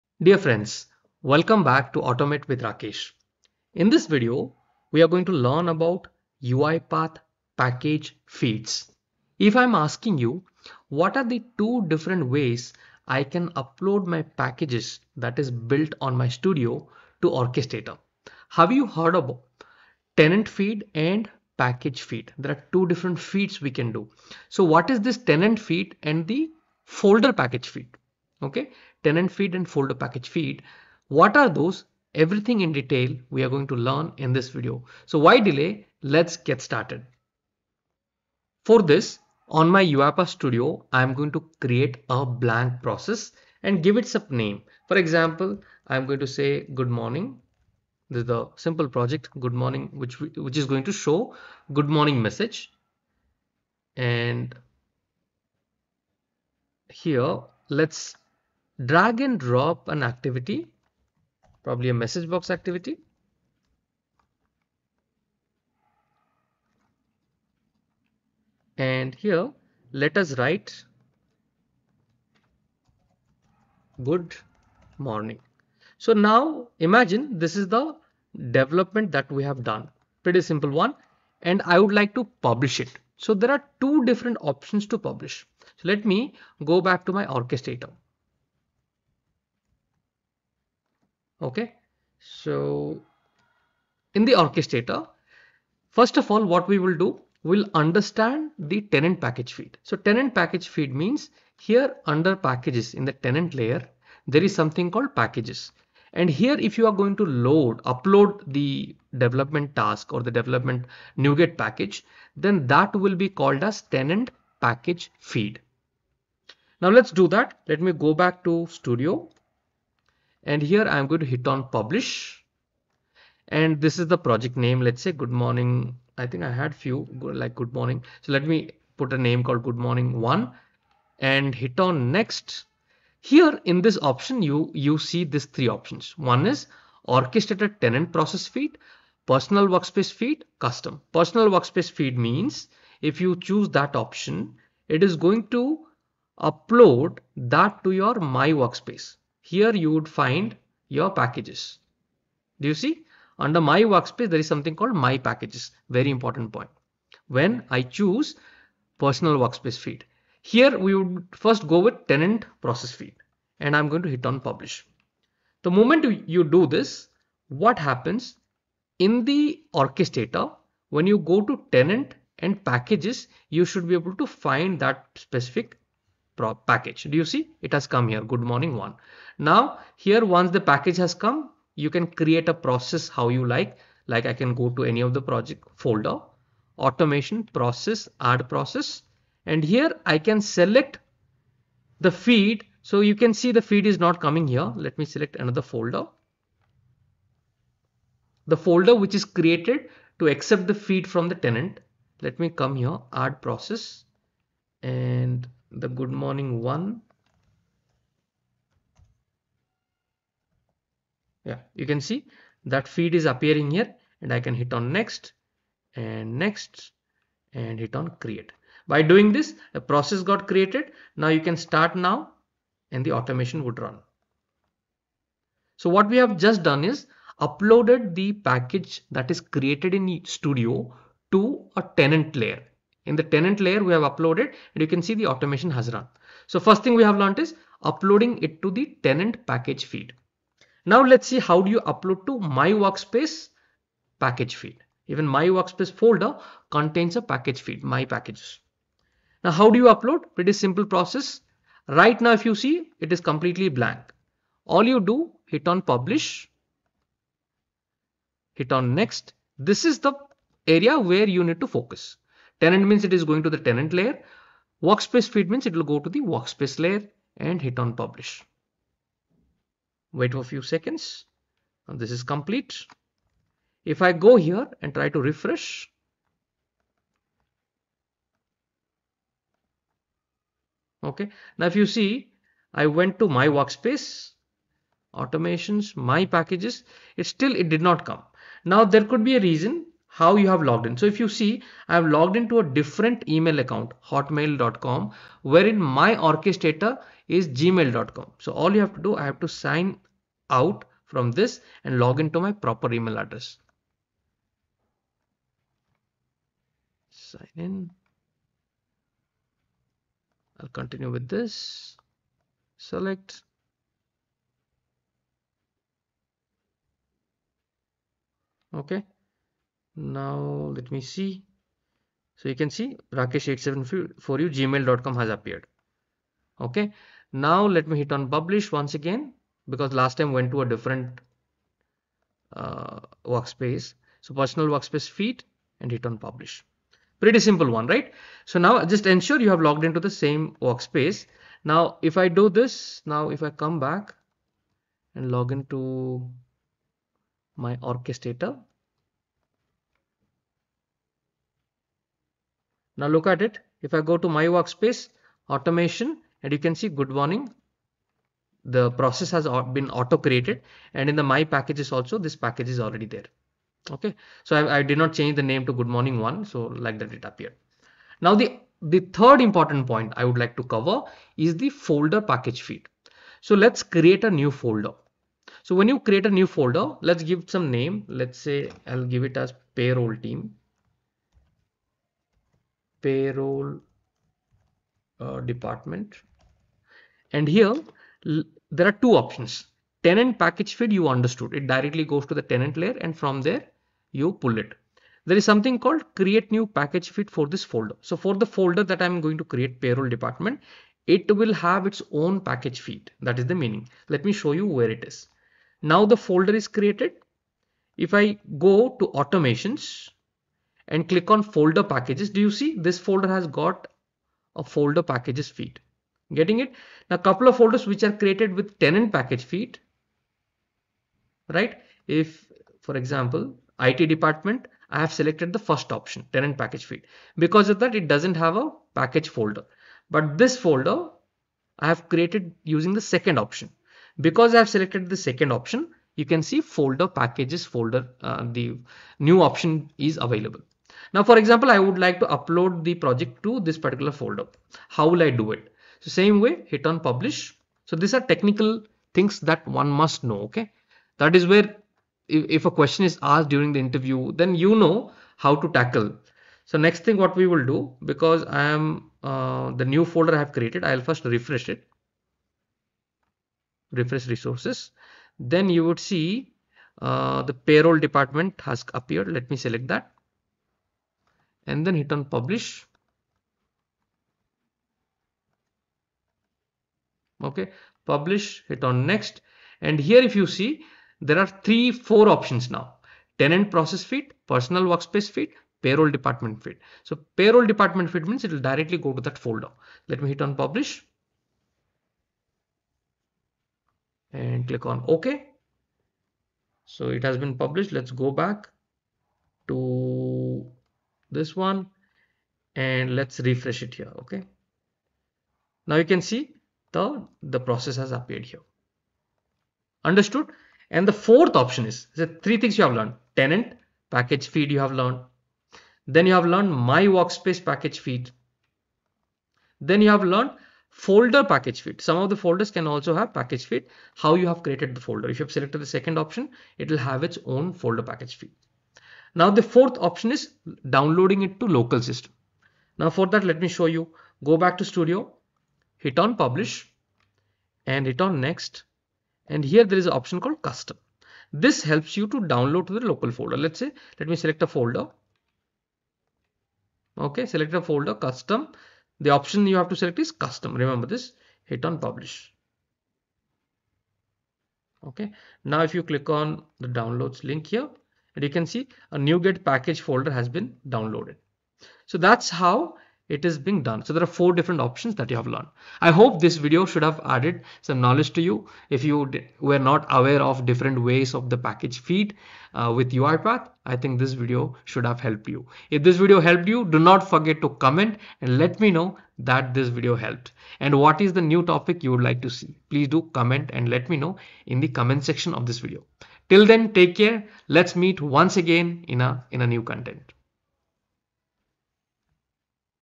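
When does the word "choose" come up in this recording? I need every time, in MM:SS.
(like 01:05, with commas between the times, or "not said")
02:23, 02:37.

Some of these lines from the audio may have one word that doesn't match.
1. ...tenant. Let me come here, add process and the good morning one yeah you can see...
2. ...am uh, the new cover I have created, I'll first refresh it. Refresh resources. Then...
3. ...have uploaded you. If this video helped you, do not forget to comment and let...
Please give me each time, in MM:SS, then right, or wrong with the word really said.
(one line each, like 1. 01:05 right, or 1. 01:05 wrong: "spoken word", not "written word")
1. 03:21 right
2. 07:38 wrong: "folder", not "cover"
3. 09:35 wrong: "helped", not "uploaded".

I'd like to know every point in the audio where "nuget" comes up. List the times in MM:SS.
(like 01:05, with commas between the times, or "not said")
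01:51, 09:19.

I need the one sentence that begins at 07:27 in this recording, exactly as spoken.
So these are technical things that one must know.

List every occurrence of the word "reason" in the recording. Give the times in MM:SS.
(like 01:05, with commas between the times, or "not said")
04:49.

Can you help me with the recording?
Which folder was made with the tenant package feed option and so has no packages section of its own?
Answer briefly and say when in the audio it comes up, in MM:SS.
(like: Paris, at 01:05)
IT department, at 07:03.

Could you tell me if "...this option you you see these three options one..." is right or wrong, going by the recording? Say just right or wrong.
right.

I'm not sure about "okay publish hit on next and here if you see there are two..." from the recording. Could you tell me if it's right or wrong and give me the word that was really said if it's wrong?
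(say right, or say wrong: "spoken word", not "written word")
wrong: "three", not "two".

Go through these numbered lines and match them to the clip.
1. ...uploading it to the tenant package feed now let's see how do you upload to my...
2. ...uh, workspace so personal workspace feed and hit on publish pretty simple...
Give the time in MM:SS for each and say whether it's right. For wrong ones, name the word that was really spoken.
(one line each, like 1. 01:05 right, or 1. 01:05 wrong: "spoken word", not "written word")
1. 03:57 right
2. 05:32 right.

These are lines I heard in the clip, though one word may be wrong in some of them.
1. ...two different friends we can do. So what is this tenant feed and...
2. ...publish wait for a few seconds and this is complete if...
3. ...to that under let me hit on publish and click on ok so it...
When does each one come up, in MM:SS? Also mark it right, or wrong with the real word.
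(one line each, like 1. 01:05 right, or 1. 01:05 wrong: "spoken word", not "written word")
1. 00:22 wrong: "feeds", not "friends"
2. 04:27 right
3. 08:09 wrong: "folder", not "under".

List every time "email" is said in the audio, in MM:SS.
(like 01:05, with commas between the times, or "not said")
04:53, 05:02.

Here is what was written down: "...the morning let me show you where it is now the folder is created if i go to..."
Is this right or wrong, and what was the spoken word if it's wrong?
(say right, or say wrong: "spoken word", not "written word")
wrong: "meaning", not "morning".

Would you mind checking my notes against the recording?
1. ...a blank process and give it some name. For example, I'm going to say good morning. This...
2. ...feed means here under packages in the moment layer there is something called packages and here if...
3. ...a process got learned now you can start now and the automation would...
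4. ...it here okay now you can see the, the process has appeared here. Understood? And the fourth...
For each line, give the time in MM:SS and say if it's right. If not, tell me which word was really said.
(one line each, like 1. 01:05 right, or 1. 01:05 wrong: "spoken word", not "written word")
1. 00:42 right
2. 01:40 wrong: "tenant", not "moment"
3. 03:39 wrong: "created", not "learned"
4. 08:23 right.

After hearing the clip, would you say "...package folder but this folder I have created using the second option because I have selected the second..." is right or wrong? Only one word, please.
right.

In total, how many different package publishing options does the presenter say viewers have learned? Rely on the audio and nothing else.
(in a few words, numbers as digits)
4.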